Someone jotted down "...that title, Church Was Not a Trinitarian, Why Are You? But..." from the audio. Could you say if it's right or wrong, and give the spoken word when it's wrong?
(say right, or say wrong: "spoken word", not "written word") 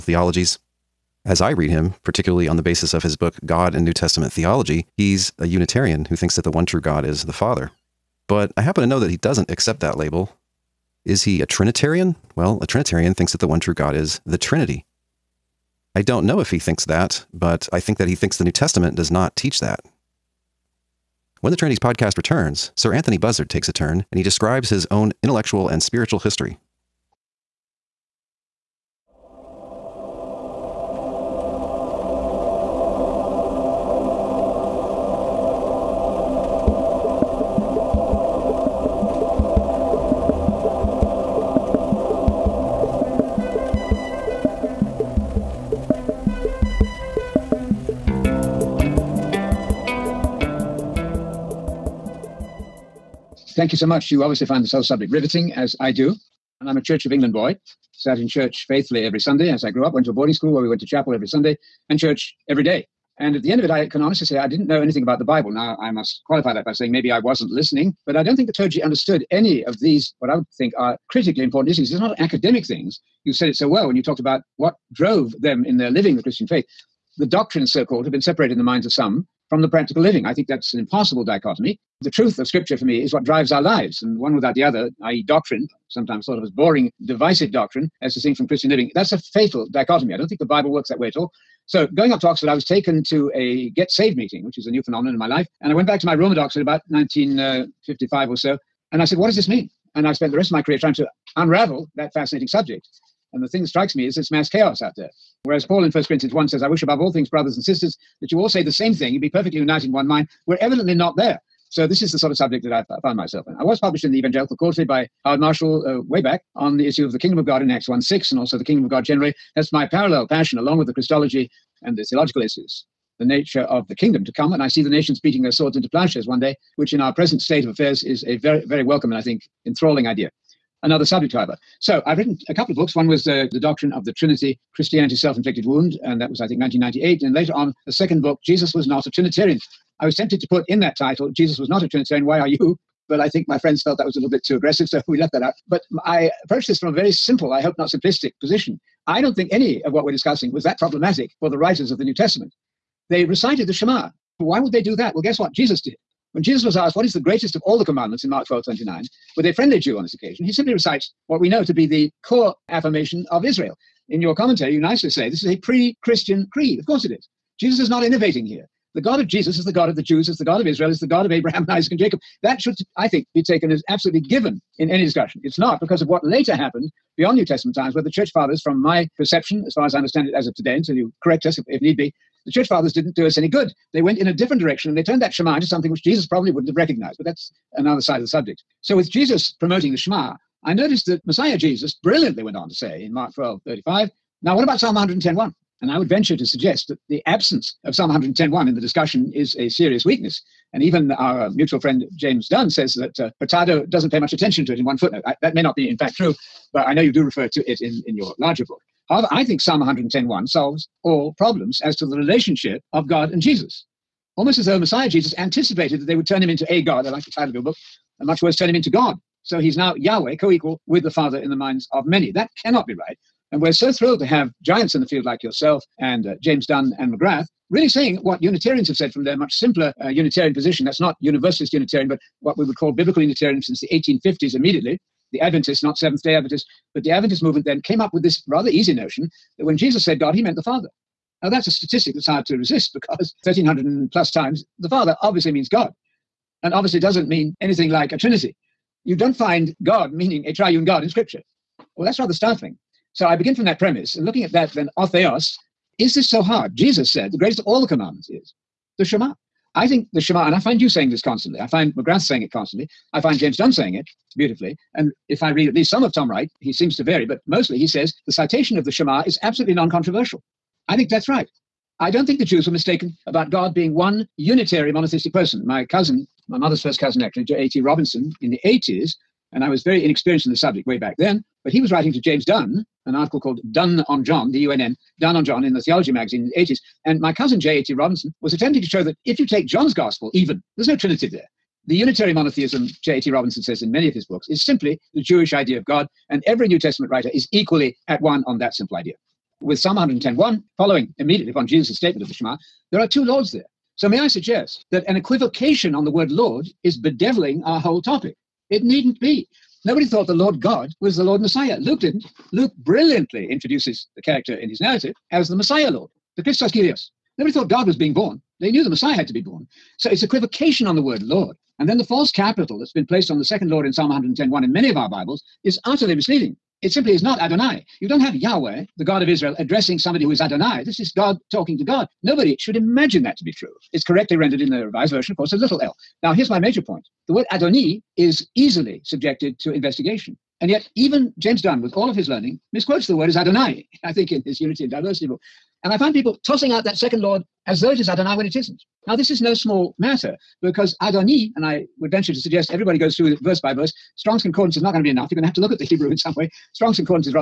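wrong: "Jesus", not "Church".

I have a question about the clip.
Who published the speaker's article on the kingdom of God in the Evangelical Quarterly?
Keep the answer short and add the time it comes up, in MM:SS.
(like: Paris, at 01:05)
Howard Marshall, at 01:55.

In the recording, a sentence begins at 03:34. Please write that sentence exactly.
Almost as though Messiah Jesus anticipated that they would turn him into a God.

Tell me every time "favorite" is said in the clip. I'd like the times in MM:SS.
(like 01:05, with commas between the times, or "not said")
not said.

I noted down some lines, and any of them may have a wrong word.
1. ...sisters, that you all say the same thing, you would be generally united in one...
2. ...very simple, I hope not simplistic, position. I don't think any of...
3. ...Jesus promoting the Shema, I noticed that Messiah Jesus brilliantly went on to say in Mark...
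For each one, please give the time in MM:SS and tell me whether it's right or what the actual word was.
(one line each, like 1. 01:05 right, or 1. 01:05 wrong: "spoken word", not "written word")
1. 01:47 wrong: "perfectly", not "generally"
2. 02:26 right
3. 03:09 right.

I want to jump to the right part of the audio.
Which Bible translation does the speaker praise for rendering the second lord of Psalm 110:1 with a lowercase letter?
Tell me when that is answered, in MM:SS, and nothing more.
05:34.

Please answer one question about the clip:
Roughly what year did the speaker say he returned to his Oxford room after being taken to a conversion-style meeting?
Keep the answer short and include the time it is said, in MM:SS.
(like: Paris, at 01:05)
1955, at 01:36.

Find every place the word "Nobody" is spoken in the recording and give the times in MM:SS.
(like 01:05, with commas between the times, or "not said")
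05:09, 05:17, 05:32.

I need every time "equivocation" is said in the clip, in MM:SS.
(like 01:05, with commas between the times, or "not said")
05:05, 05:20.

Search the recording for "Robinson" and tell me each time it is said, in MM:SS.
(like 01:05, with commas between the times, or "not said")
04:37, 04:47, 04:53.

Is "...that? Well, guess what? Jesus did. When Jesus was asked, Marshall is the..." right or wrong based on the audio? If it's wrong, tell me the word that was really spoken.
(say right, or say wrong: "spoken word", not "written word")
wrong: "What", not "Marshall".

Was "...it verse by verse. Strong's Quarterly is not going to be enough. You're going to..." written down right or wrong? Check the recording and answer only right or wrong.
wrong.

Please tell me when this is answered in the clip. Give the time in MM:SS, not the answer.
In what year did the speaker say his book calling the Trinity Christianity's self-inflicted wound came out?
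02:16.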